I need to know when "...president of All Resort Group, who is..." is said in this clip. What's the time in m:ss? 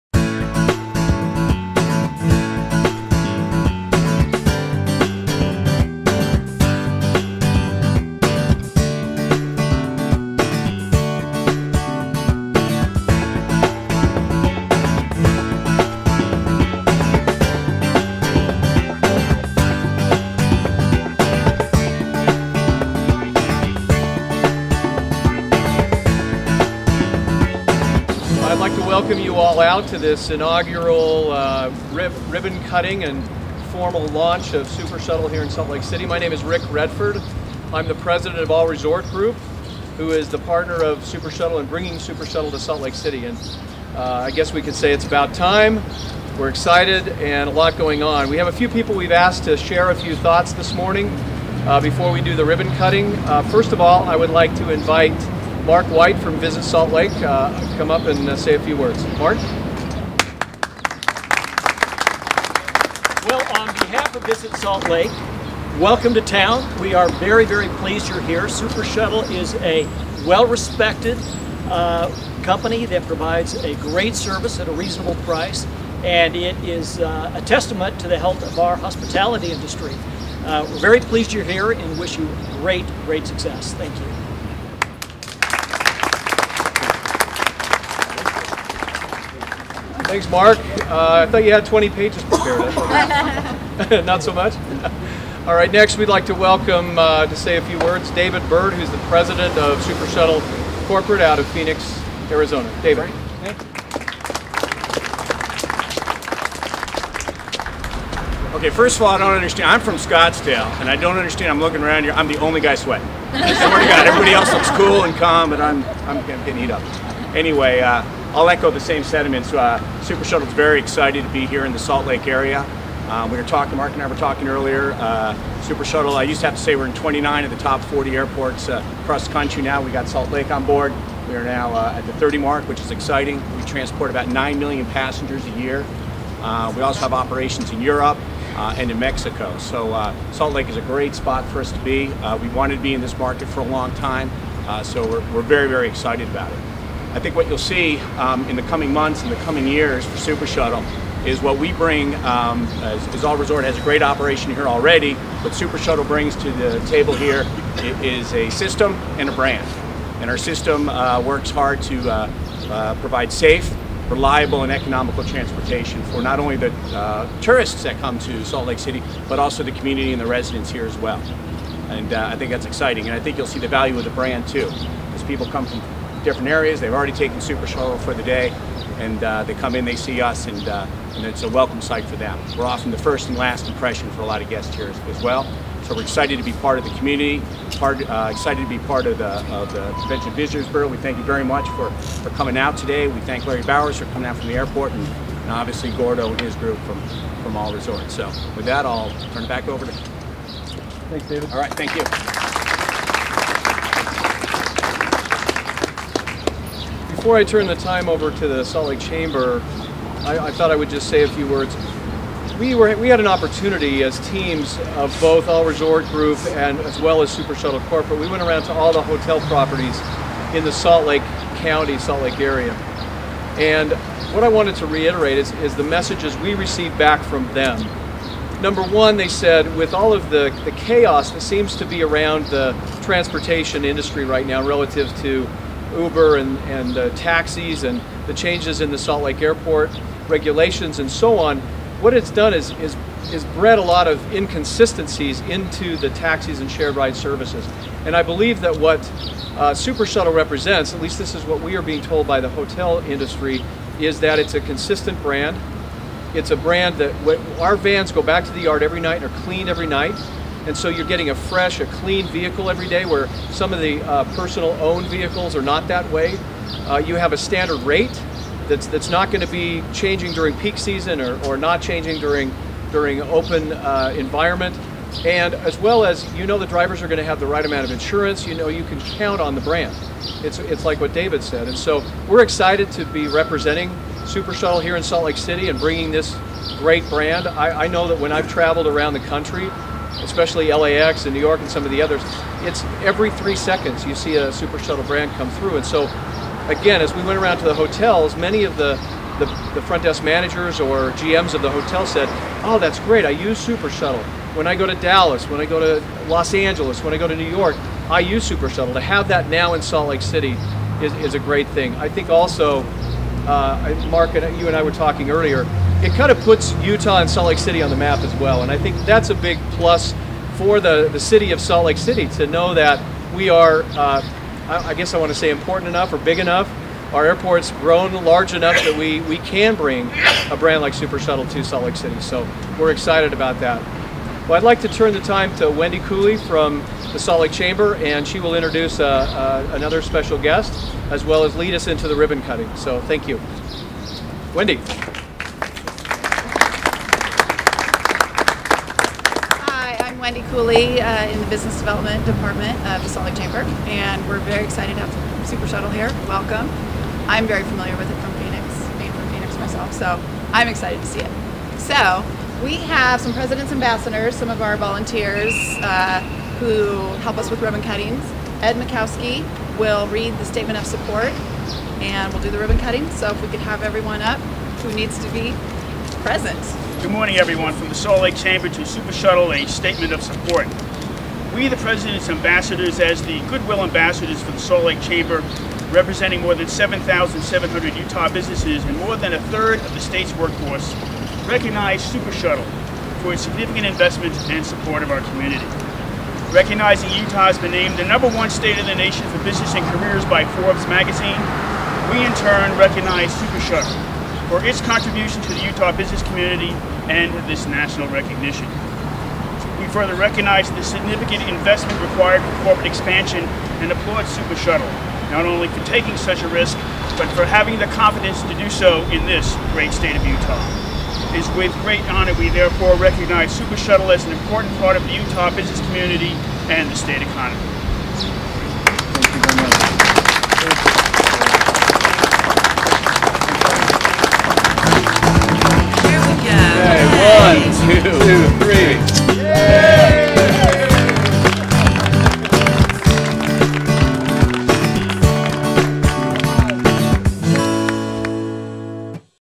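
0:37.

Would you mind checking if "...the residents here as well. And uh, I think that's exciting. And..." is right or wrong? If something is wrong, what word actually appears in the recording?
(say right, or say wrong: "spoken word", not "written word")
right.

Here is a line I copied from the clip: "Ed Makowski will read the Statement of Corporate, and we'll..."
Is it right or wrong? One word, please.
wrong.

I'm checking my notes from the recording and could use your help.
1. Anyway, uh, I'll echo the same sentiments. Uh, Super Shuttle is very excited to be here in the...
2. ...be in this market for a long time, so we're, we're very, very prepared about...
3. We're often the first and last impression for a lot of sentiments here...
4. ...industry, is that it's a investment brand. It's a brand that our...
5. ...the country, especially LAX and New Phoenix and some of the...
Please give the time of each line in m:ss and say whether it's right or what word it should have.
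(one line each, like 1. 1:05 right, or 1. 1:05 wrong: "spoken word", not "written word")
1. 1:57 right
2. 2:22 wrong: "excited", not "prepared"
3. 3:02 wrong: "guests", not "sentiments"
4. 4:13 wrong: "consistent", not "investment"
5. 4:49 wrong: "York", not "Phoenix".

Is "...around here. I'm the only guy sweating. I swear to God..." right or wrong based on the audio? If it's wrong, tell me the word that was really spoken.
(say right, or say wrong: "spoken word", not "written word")
right.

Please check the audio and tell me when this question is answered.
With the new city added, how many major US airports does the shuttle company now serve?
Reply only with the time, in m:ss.
2:12.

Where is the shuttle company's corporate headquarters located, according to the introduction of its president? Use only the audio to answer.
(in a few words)
Phoenix, Arizona.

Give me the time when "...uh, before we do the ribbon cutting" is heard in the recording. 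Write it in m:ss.
0:51.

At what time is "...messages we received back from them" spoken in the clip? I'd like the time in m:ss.
3:45.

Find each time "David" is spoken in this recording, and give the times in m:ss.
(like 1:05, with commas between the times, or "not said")
1:38, 1:42, 3:21, 4:41.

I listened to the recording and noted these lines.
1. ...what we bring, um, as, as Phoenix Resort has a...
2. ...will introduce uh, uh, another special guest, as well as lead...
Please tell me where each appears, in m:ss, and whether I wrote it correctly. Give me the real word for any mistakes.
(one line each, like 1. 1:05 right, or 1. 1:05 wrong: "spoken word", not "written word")
1. 2:31 wrong: "All", not "Phoenix"
2. 5:38 right.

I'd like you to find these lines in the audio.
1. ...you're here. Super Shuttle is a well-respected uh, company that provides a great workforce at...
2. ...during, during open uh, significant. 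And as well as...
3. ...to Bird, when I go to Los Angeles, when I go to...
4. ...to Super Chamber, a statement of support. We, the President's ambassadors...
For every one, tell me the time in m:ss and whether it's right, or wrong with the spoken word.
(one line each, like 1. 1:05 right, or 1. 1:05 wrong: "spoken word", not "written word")
1. 1:08 wrong: "service", not "workforce"
2. 4:32 wrong: "environment", not "significant"
3. 5:04 wrong: "Dallas", not "Bird"
4. 6:18 wrong: "Shuttle", not "Chamber".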